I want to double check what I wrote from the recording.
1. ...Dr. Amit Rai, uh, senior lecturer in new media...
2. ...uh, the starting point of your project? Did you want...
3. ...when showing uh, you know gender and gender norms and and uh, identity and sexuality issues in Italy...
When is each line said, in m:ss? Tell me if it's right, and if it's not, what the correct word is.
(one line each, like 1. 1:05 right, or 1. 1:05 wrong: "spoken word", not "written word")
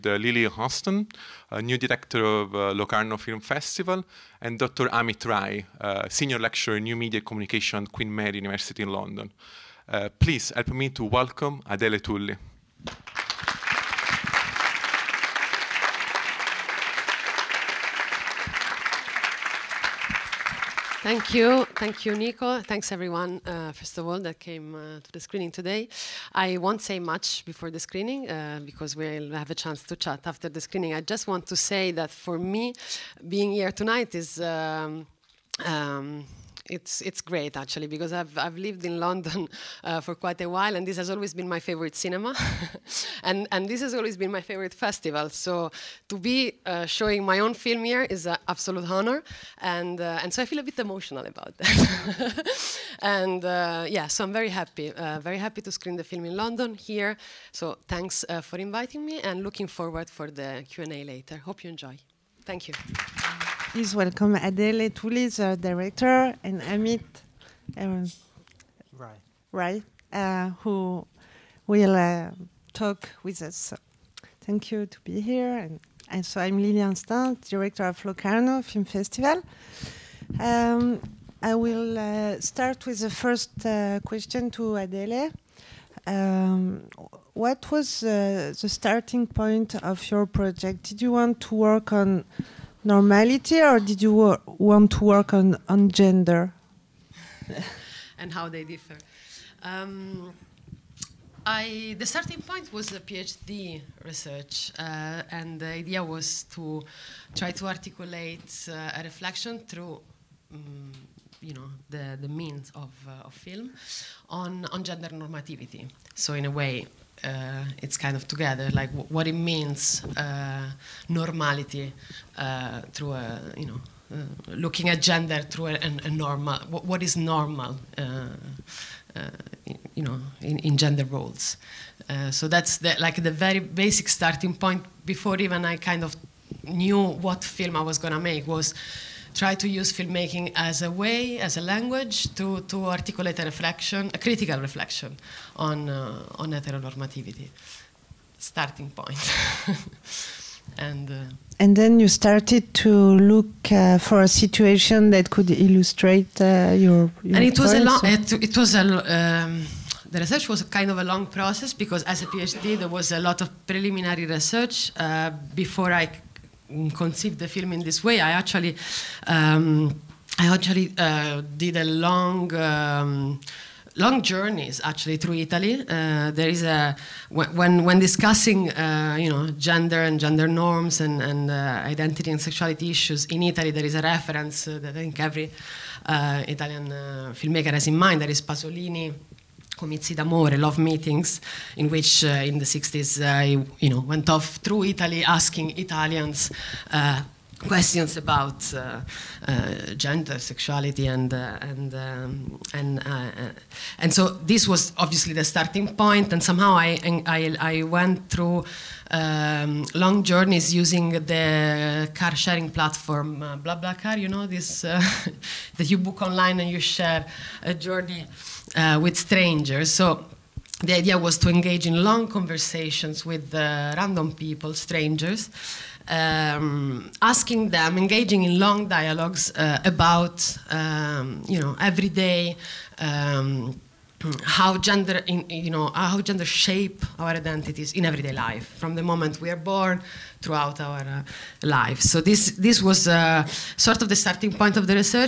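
1. 0:04 right
2. 1:28 right
3. 2:57 wrong: "discussing", not "showing".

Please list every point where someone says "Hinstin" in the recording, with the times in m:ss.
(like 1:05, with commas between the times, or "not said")
0:00, 1:16.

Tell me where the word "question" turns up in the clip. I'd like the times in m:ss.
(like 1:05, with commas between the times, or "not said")
1:24, 3:17.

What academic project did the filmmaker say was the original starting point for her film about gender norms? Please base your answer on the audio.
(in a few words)
PhD research.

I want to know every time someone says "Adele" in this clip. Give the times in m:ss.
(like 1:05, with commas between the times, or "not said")
0:11, 1:04, 1:24.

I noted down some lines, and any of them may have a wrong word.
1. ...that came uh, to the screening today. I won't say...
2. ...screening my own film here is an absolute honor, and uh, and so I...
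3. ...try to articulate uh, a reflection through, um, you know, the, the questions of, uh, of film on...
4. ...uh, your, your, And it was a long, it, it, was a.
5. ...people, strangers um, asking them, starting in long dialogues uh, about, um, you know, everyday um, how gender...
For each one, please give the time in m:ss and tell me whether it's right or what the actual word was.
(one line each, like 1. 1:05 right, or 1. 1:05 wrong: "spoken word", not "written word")
1. 0:24 right
2. 0:46 wrong: "showing", not "screening"
3. 1:47 wrong: "means", not "questions"
4. 2:36 right
5. 3:44 wrong: "engaging", not "starting".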